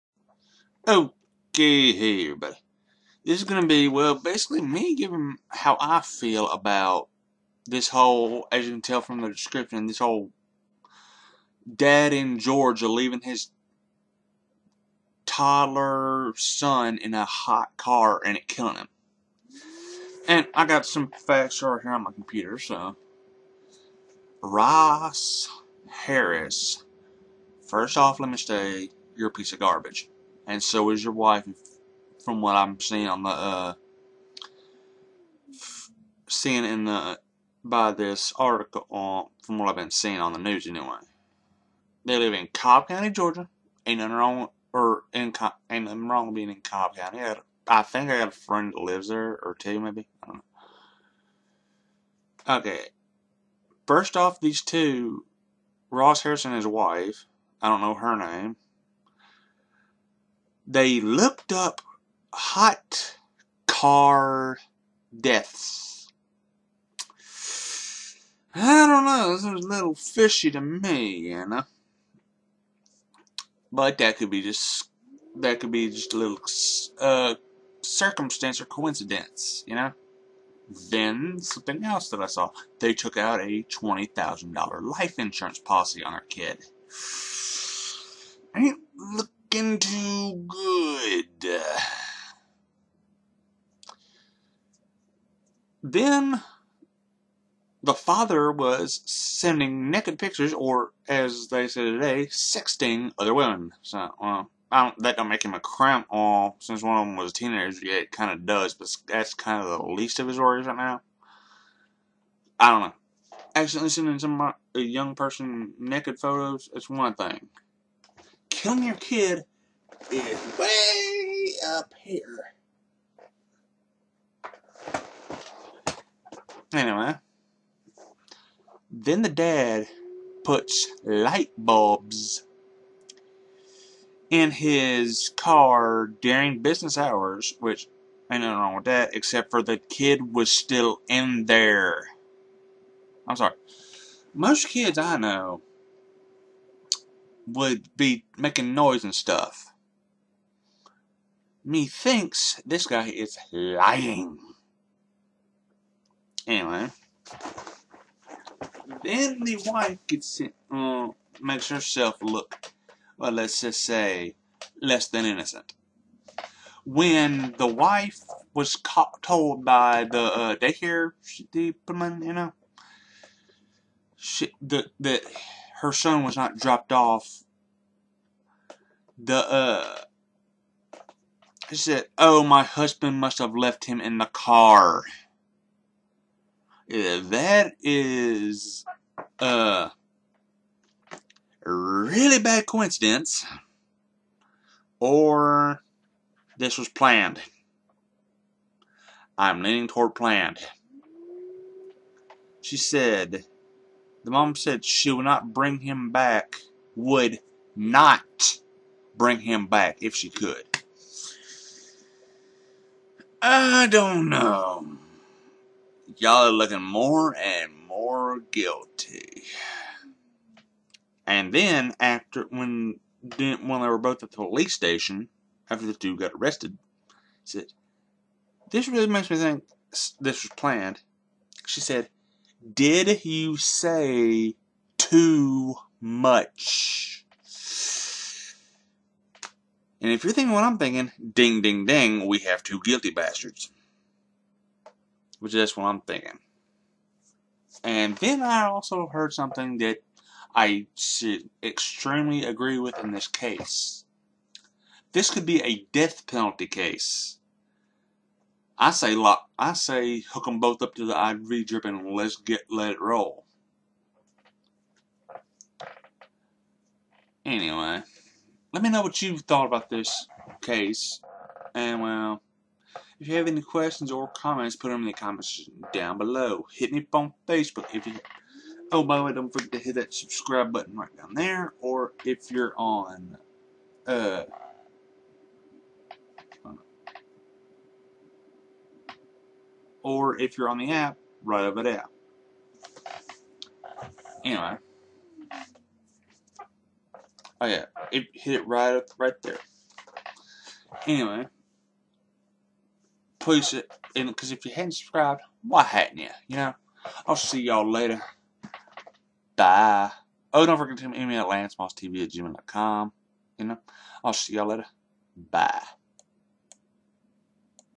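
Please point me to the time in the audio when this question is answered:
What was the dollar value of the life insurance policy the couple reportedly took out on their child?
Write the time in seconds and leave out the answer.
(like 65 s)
83 s.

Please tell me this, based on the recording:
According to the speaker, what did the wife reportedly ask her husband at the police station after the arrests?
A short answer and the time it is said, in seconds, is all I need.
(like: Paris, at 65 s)
Did you say too much?, at 232 s.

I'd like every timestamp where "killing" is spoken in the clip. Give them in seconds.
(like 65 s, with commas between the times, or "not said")
18 s, 118 s.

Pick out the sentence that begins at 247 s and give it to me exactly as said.
And then I also heard something that I should extremely agree with in this case.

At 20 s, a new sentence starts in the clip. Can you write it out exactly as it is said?
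And I got some facts right here on my computer, so.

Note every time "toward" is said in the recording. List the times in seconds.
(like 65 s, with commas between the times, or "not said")
199 s.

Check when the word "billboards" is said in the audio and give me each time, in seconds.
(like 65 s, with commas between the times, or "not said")
not said.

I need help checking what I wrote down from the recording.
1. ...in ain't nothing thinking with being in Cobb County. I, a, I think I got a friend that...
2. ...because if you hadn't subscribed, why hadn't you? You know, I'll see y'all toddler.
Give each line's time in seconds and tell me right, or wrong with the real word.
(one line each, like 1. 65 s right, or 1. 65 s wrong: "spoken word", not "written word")
1. 45 s wrong: "wrong", not "thinking"
2. 304 s wrong: "later", not "toddler".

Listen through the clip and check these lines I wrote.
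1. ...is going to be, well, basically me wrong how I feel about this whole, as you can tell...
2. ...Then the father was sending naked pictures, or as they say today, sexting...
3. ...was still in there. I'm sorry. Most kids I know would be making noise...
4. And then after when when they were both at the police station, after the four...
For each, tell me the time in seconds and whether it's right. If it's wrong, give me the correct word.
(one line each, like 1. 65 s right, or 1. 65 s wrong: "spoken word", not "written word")
1. 3 s wrong: "giving", not "wrong"
2. 95 s right
3. 140 s right
4. 221 s wrong: "two", not "four".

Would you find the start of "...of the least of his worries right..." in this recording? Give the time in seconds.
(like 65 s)
109 s.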